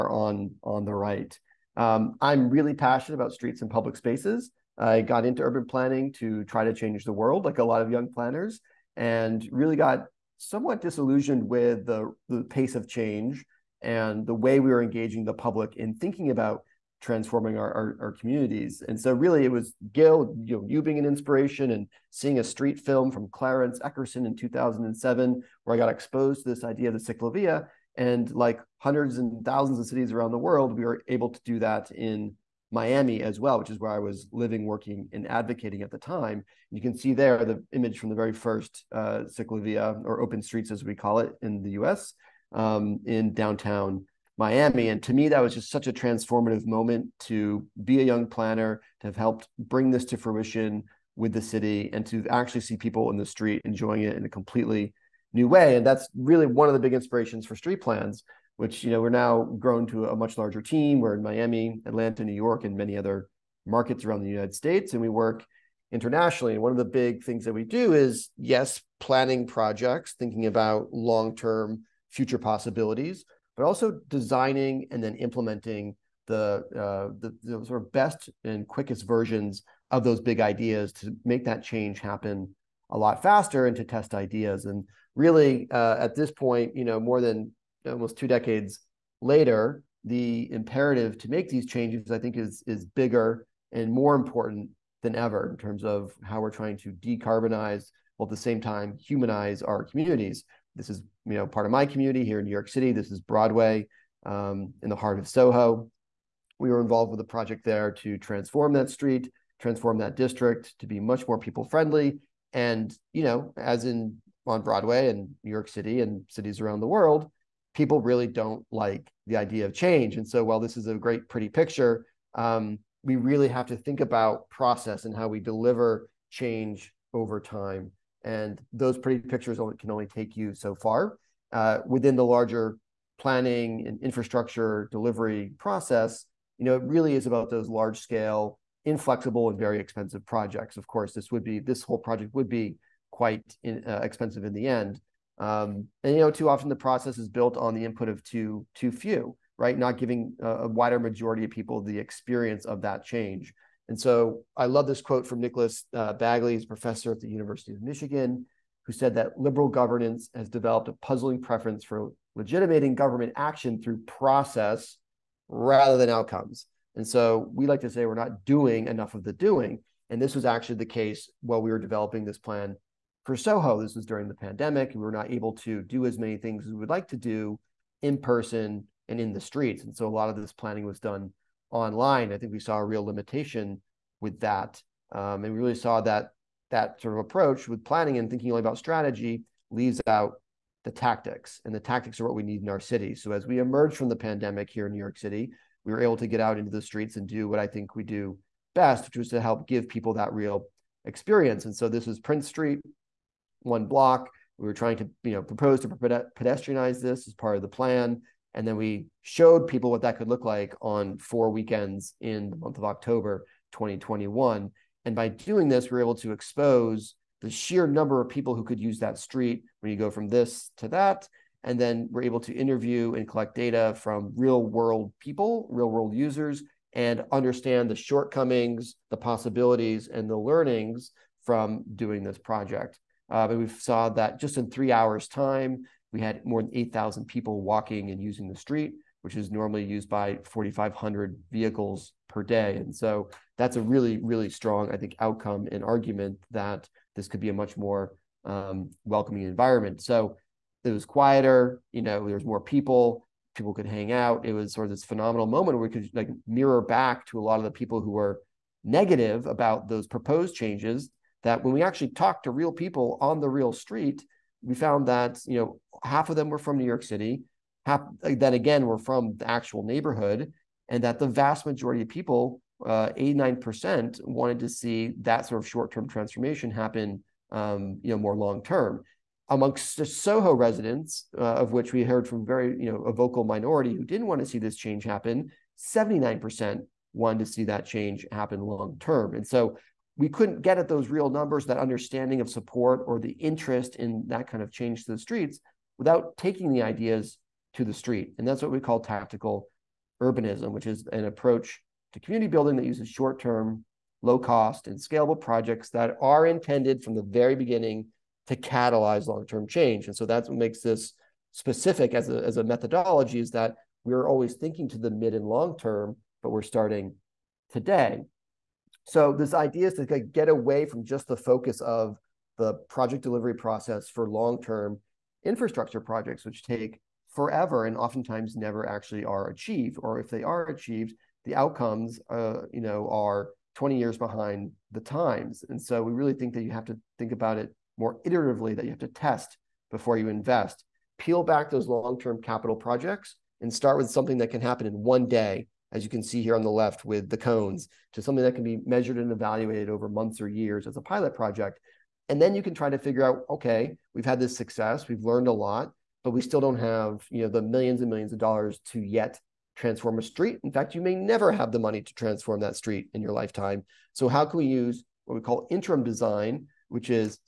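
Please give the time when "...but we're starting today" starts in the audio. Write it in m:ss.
5:16.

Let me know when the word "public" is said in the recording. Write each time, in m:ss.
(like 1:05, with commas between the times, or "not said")
0:03, 0:15.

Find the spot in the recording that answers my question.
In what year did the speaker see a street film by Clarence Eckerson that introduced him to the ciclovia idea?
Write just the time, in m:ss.
0:24.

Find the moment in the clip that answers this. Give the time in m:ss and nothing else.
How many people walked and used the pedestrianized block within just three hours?
3:56.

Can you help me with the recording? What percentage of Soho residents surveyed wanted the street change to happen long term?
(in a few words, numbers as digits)
79%.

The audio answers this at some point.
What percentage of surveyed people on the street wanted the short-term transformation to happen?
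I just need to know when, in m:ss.
4:33.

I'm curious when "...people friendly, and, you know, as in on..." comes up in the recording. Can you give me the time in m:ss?
1:51.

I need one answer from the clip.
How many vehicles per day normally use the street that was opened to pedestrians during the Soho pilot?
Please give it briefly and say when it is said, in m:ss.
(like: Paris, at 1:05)
4,500, at 4:00.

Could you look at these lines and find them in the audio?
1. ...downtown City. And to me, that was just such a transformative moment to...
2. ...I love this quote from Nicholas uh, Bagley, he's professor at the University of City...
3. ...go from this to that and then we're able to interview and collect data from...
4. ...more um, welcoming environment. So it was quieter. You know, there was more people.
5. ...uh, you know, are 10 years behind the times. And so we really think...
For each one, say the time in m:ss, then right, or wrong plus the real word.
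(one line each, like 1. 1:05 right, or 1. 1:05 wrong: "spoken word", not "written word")
1. 0:43 wrong: "Miami", not "City"
2. 2:34 wrong: "Michigan", not "City"
3. 3:39 right
4. 4:07 right
5. 5:32 wrong: "20", not "10".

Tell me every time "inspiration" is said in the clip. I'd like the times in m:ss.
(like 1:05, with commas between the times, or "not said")
0:21, 0:56.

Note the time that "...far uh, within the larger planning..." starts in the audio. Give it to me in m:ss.
2:10.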